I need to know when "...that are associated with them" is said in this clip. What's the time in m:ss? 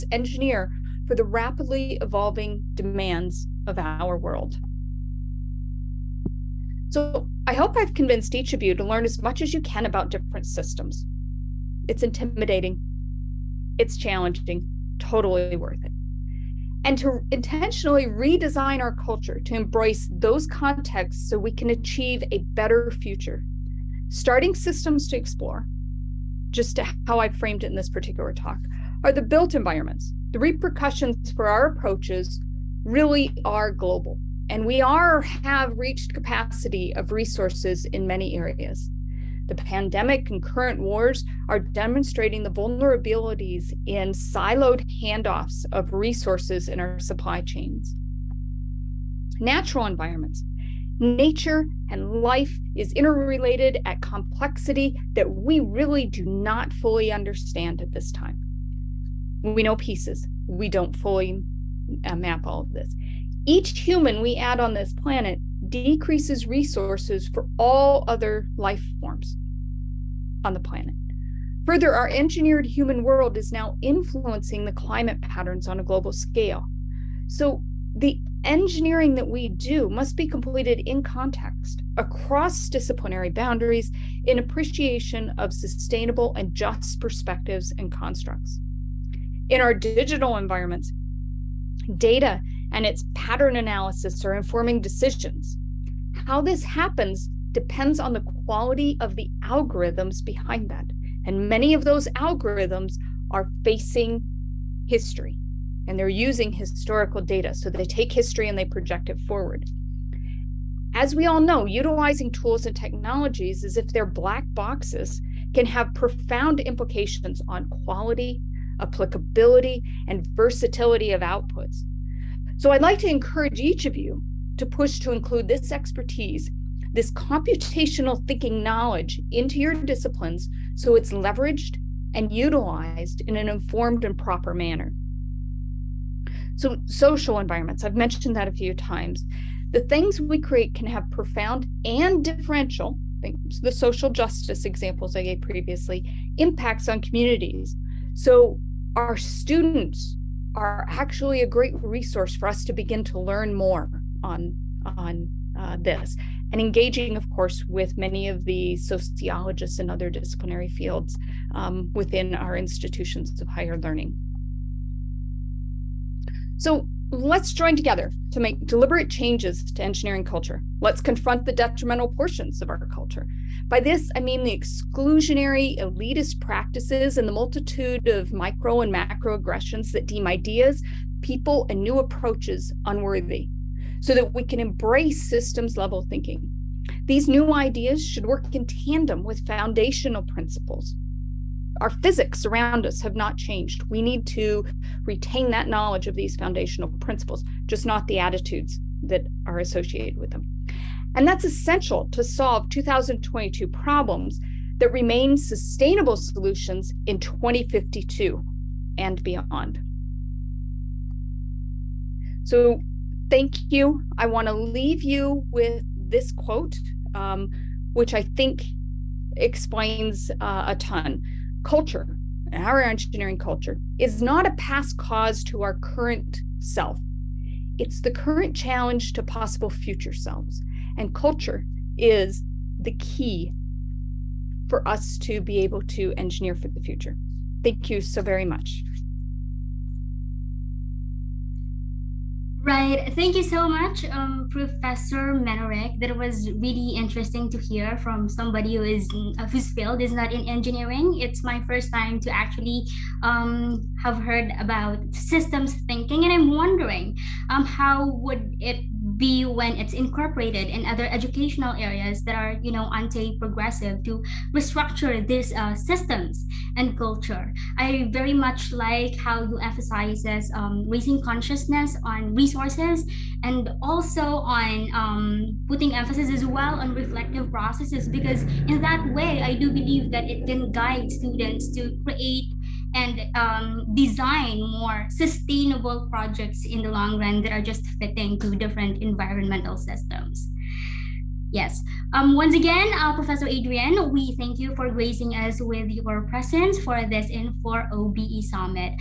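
3:19.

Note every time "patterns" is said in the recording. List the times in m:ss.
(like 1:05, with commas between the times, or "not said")
1:15, 1:33.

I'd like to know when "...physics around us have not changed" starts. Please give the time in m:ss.
3:11.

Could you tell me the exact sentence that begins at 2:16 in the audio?
So social environments, I've mentioned that a few times.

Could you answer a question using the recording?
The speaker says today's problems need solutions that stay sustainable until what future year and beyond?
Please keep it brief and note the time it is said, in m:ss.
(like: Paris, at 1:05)
2052, at 3:27.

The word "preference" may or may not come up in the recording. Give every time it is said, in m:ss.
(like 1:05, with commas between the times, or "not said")
not said.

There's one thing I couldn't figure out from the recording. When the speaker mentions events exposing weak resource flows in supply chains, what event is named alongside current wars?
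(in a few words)
The pandemic.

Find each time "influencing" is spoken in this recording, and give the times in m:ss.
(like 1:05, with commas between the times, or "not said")
1:13.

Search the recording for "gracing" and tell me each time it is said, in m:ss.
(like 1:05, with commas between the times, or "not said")
4:54.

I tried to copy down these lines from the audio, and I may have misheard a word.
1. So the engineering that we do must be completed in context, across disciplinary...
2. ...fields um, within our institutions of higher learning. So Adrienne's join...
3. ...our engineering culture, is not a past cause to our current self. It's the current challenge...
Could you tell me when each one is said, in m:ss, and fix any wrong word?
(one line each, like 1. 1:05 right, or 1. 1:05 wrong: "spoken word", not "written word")
1. 1:17 right
2. 2:40 wrong: "Let", not "Adrienne"
3. 3:42 right.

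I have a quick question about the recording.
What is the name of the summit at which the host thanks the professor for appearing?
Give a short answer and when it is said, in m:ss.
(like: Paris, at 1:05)
IN4OBE Summit, at 4:57.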